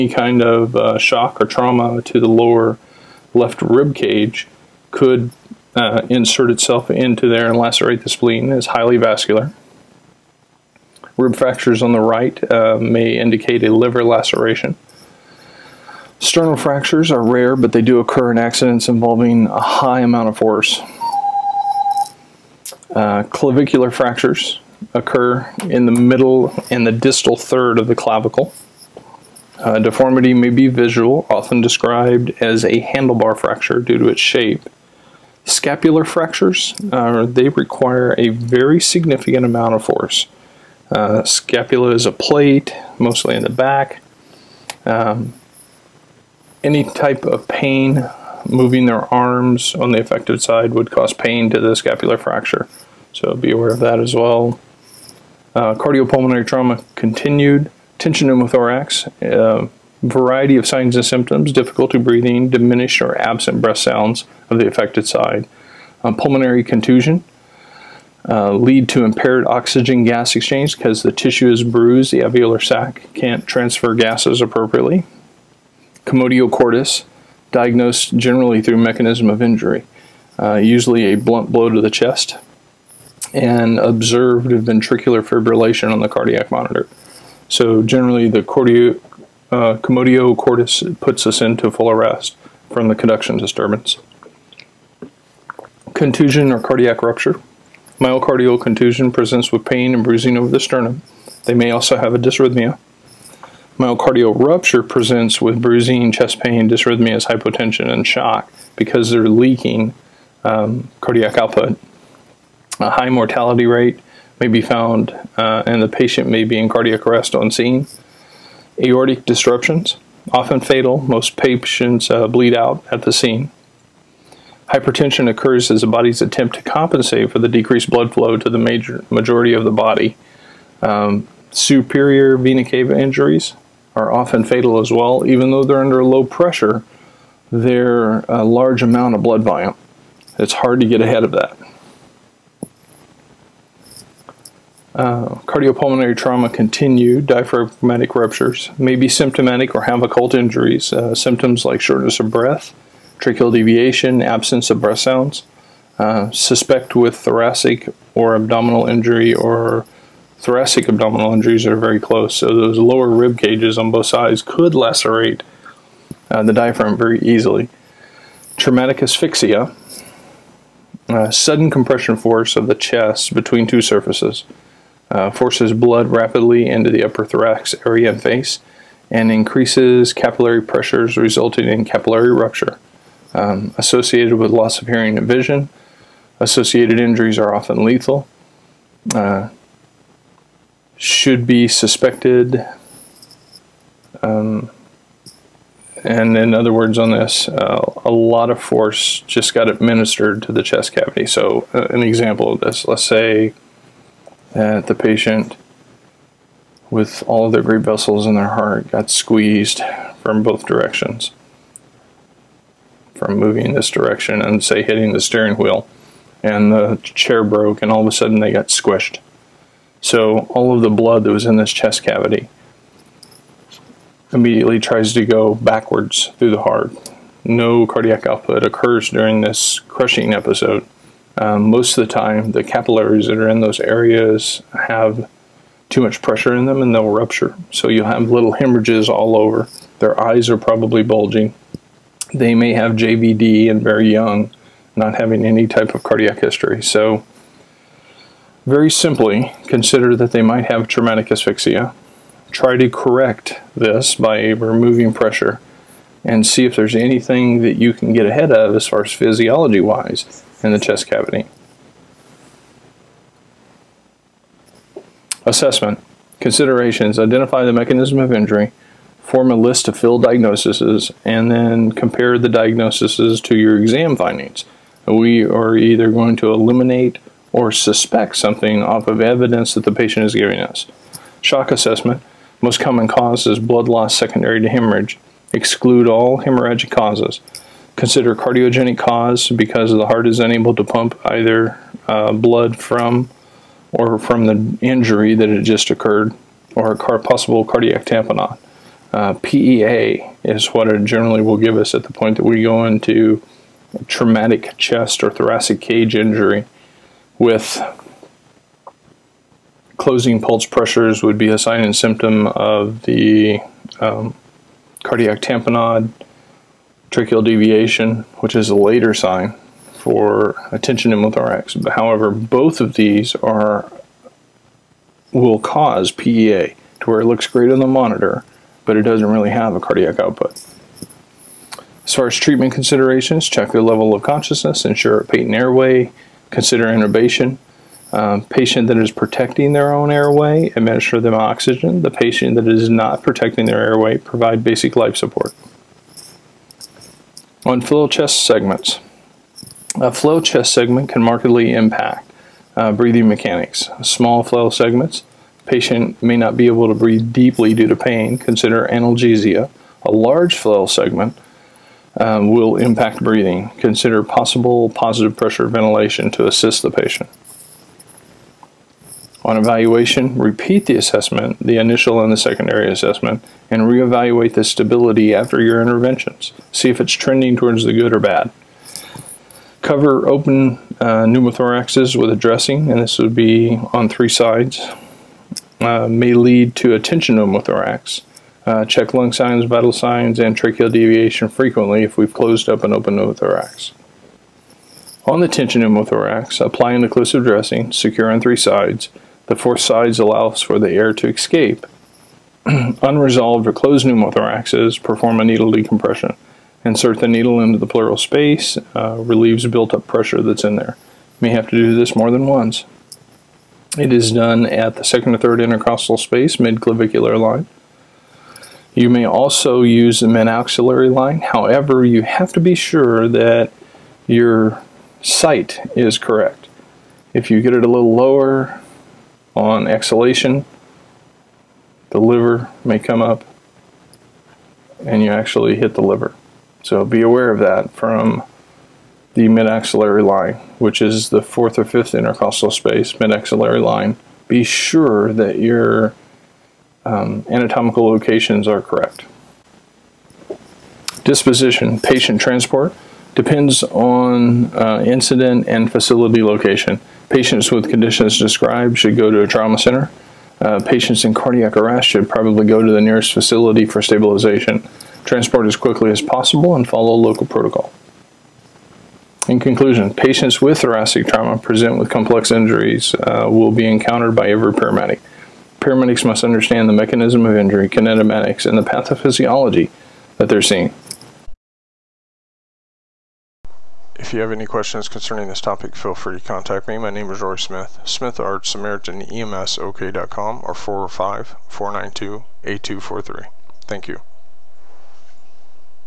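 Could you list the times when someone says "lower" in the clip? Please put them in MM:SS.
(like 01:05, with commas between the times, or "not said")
00:02, 02:42, 07:08.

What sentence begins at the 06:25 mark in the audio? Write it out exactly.
Uh, may lead to tension pneumothorax.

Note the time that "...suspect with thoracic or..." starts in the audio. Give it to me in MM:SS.
02:36.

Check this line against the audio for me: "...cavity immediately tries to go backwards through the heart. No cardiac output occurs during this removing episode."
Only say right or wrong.
wrong.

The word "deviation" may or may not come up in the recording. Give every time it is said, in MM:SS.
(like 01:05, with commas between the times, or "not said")
02:33, 05:17, 06:30.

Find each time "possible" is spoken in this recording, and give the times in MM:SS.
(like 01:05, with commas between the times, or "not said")
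04:57, 06:04, 07:46.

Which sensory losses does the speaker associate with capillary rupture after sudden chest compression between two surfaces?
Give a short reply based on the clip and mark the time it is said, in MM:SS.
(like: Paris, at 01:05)
hearing and vision, at 03:04.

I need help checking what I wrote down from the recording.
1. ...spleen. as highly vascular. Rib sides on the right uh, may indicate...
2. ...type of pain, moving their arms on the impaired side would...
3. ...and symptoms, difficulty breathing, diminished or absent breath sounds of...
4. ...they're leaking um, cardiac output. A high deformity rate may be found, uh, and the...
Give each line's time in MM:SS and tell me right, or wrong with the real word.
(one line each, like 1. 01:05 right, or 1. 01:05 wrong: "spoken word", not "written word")
1. 00:08 wrong: "fractures", not "sides"
2. 00:46 wrong: "affected", not "impaired"
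3. 01:00 right
4. 01:49 wrong: "mortality", not "deformity".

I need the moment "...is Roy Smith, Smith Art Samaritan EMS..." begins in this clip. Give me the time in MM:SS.
08:07.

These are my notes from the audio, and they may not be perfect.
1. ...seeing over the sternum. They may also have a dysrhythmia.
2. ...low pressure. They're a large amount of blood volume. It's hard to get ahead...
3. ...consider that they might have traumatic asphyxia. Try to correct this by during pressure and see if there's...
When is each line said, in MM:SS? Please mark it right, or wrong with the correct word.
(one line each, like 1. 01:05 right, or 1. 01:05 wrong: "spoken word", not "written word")
1. 01:40 wrong: "bruising", not "seeing"
2. 02:16 right
3. 04:09 wrong: "removing", not "during".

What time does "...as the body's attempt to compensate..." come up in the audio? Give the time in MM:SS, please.
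02:05.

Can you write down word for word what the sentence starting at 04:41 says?
Shock assessment, most common cause is blood loss secondary to hemorrhage.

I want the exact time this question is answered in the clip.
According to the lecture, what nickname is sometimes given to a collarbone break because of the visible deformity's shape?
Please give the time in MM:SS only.
00:32.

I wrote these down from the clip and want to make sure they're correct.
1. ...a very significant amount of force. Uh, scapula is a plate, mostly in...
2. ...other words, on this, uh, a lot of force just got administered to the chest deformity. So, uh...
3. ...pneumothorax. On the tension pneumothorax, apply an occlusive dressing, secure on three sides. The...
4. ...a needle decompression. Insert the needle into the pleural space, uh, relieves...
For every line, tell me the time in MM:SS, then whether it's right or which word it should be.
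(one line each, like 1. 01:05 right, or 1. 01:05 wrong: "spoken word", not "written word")
1. 00:38 right
2. 03:16 wrong: "cavity", not "deformity"
3. 06:33 right
4. 06:45 right.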